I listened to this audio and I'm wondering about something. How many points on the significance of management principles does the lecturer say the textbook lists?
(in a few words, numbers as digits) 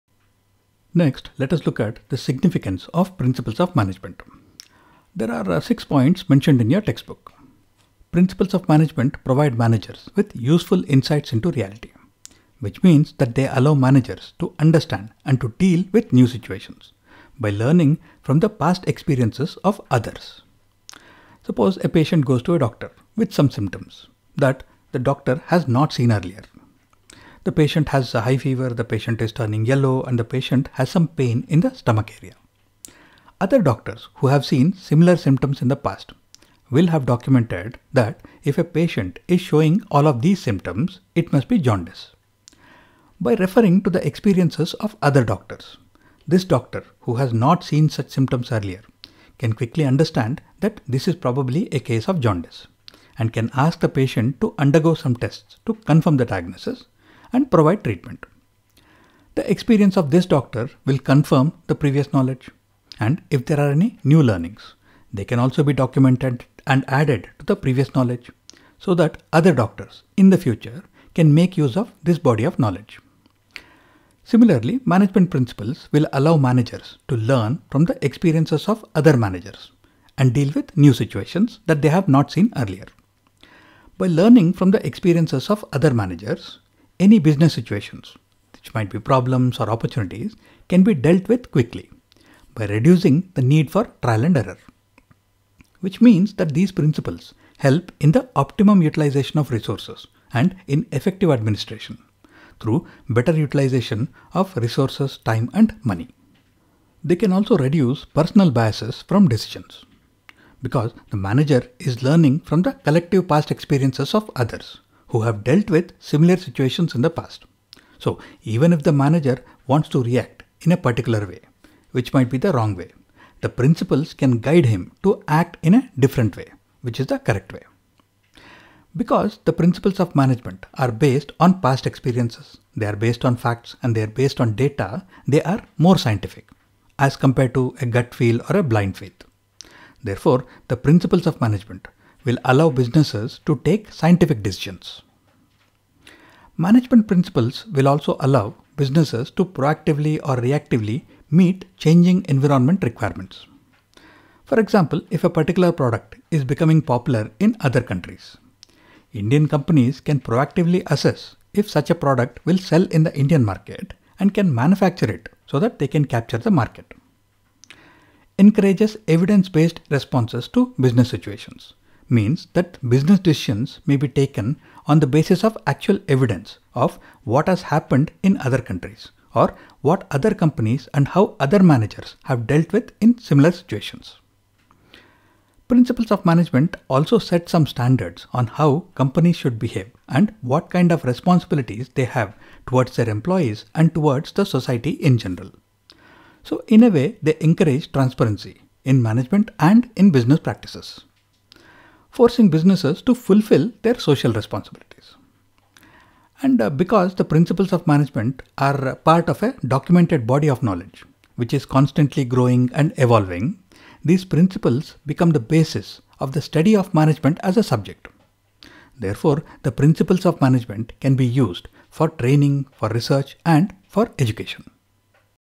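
6.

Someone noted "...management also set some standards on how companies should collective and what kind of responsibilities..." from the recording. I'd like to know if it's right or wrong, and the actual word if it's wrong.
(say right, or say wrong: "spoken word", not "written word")
wrong: "behave", not "collective".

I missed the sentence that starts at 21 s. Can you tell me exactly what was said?
Suppose a patient goes to a doctor with some symptoms that the doctor has not seen earlier.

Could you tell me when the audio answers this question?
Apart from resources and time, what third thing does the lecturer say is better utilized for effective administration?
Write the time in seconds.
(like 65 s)
105 s.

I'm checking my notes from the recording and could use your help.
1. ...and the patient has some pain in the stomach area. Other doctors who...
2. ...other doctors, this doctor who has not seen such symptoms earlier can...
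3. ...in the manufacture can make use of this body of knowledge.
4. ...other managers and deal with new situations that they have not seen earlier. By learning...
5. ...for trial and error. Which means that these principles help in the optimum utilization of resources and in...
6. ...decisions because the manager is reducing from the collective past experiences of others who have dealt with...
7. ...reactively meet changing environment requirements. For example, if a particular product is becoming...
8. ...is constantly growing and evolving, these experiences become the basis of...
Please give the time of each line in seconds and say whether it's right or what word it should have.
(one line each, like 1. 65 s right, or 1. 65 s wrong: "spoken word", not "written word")
1. 30 s right
2. 45 s right
3. 70 s wrong: "future", not "manufacture"
4. 78 s right
5. 93 s right
6. 109 s wrong: "learning", not "reducing"
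7. 150 s right
8. 211 s wrong: "principles", not "experiences".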